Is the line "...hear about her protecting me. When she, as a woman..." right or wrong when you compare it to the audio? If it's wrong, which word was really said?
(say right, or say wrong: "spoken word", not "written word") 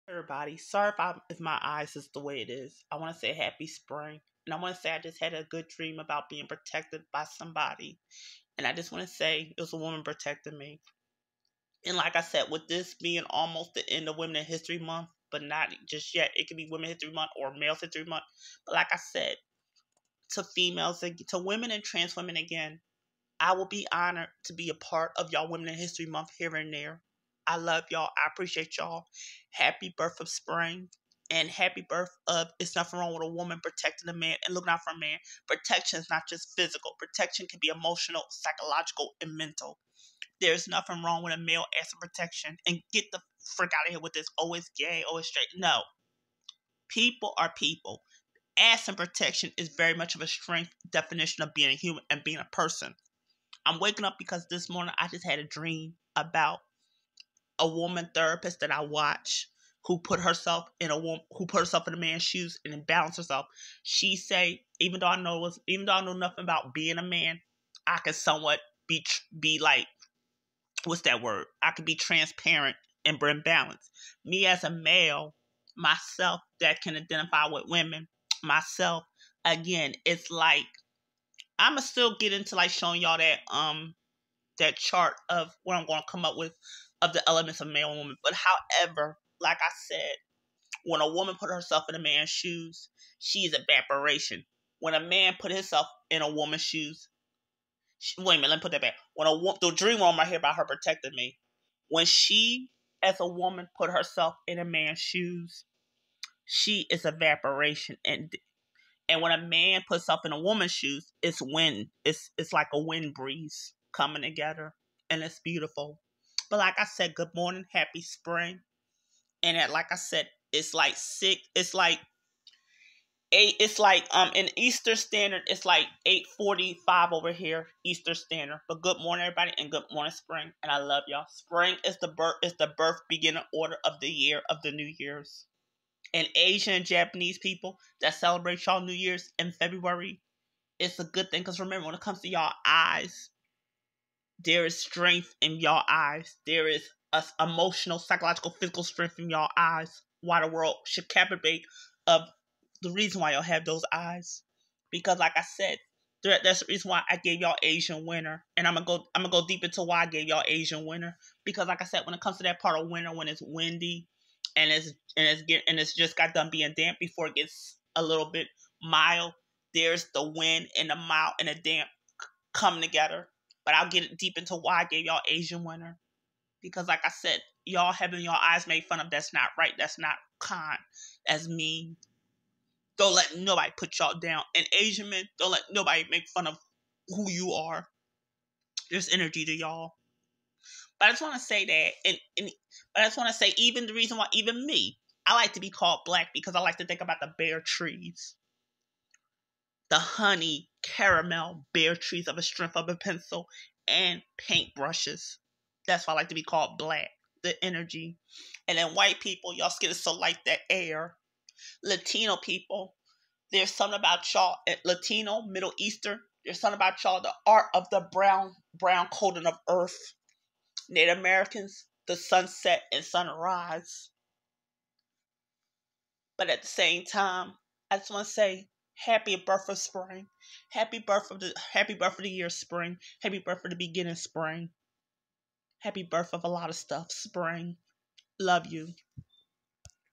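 right.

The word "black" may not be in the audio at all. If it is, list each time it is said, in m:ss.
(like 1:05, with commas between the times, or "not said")
3:16, 3:26.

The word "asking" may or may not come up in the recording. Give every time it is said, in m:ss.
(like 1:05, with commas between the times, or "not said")
0:41, 0:48.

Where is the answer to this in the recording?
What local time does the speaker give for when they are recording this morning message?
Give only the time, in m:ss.
2:06.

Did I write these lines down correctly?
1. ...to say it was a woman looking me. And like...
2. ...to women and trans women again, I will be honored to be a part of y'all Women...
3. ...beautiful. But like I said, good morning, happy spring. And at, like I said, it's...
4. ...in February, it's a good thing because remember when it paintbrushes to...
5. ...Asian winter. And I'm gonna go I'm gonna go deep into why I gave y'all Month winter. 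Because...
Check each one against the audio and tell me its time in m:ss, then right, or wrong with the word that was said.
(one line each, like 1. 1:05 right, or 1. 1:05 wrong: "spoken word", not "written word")
1. 0:09 wrong: "protecting", not "looking"
2. 0:21 right
3. 1:55 right
4. 2:19 wrong: "comes", not "paintbrushes"
5. 2:37 wrong: "Asian", not "Month".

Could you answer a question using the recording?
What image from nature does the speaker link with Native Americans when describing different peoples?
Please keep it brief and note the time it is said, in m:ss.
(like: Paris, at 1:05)
Sunset and sunrise, at 3:42.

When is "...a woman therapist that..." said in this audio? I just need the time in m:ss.
0:57.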